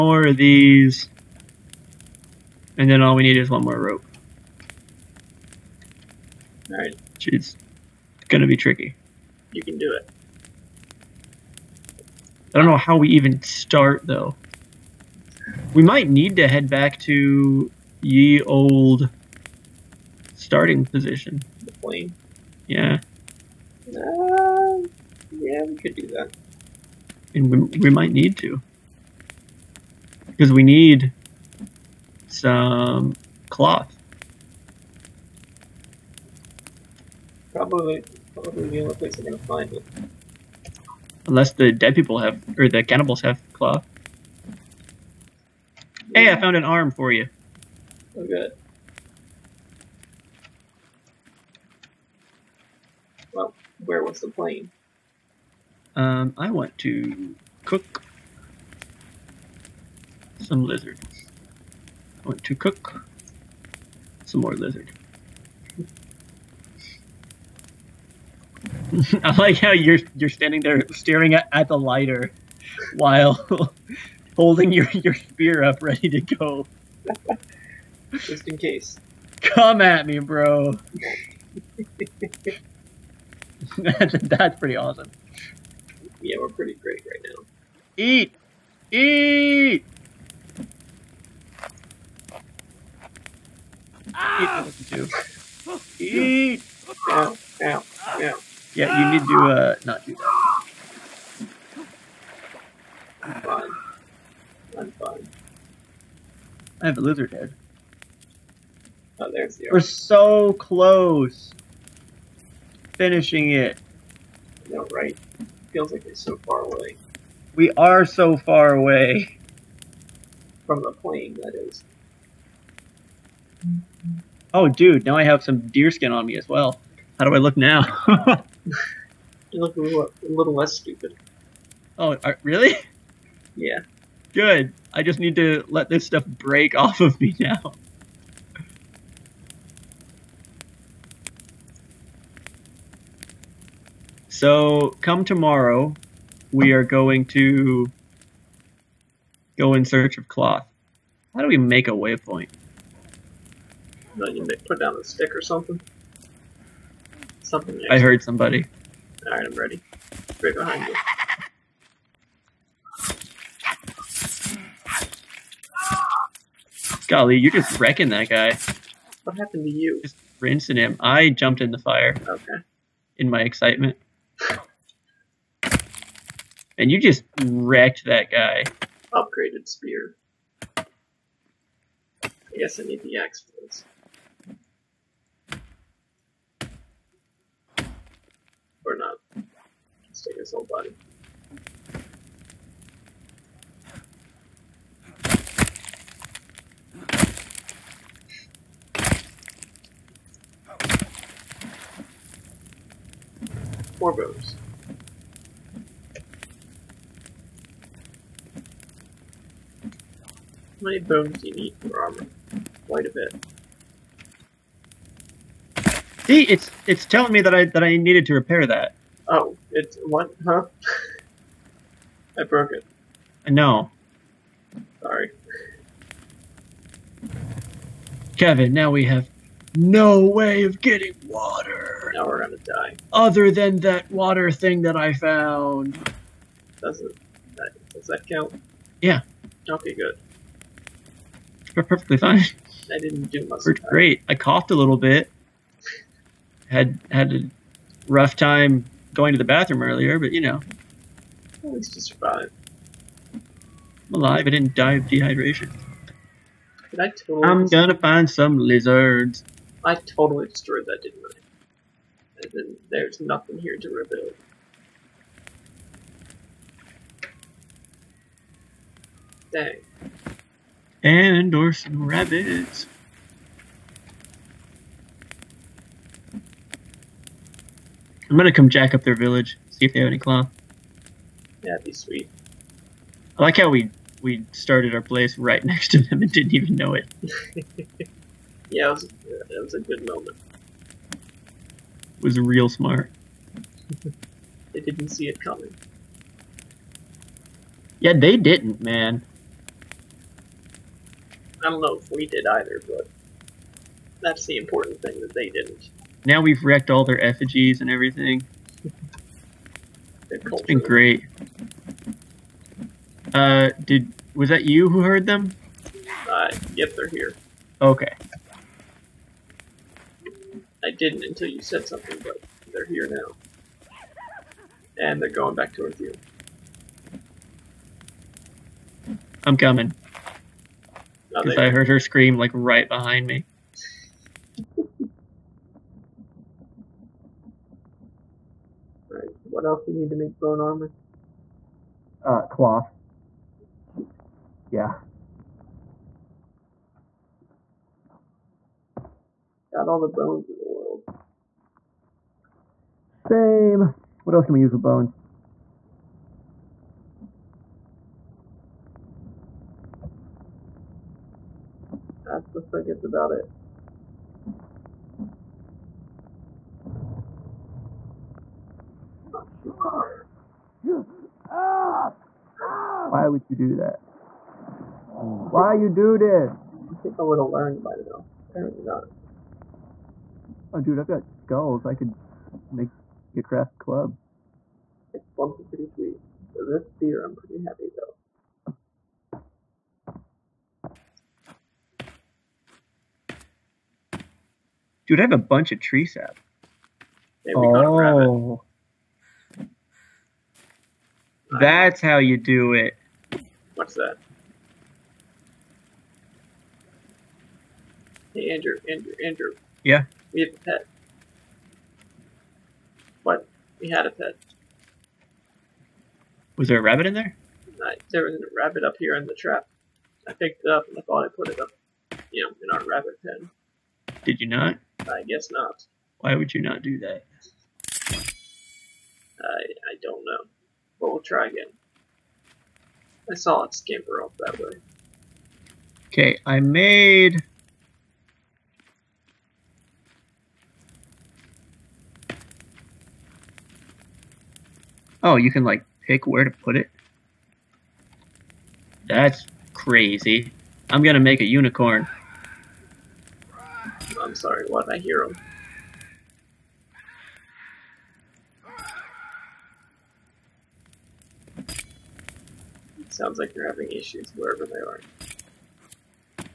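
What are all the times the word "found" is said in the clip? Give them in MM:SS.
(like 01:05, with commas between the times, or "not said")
00:46, 03:55.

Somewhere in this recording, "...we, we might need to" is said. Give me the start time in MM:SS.
00:27.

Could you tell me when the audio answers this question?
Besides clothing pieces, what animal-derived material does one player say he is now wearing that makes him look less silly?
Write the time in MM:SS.
02:05.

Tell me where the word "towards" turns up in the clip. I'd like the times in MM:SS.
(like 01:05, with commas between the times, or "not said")
05:25.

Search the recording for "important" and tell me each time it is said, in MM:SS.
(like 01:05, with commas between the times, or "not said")
05:04.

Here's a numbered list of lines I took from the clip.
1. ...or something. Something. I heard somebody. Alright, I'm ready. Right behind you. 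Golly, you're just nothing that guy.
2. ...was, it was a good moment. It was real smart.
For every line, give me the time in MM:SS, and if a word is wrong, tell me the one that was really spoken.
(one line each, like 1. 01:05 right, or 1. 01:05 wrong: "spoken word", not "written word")
1. 02:35 wrong: "wrecking", not "nothing"
2. 04:48 right.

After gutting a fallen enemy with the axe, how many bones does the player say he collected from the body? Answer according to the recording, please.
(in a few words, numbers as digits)
4.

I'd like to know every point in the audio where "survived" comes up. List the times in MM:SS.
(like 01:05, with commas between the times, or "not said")
04:12.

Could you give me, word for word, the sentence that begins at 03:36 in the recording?
See, it's it's telling me that I that I needed to repair that.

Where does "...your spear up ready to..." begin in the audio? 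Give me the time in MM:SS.
01:14.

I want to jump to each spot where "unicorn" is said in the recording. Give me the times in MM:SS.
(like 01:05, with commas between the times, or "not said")
07:31.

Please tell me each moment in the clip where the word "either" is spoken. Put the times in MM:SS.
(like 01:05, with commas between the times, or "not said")
05:02.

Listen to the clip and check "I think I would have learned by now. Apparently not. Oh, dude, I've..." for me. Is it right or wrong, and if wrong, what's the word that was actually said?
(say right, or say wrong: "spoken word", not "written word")
right.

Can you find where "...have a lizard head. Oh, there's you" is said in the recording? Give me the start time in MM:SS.
01:46.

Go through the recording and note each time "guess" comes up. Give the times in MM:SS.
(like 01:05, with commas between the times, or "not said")
03:02, 07:05.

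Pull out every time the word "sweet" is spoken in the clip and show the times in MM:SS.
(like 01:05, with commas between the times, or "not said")
04:41, 06:25.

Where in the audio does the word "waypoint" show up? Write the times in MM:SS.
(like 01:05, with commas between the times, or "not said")
02:31.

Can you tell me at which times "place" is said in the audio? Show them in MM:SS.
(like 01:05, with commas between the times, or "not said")
00:38, 04:45.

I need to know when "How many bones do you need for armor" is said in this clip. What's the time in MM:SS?
03:29.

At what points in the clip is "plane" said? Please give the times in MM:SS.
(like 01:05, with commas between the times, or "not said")
00:21, 00:54, 02:00.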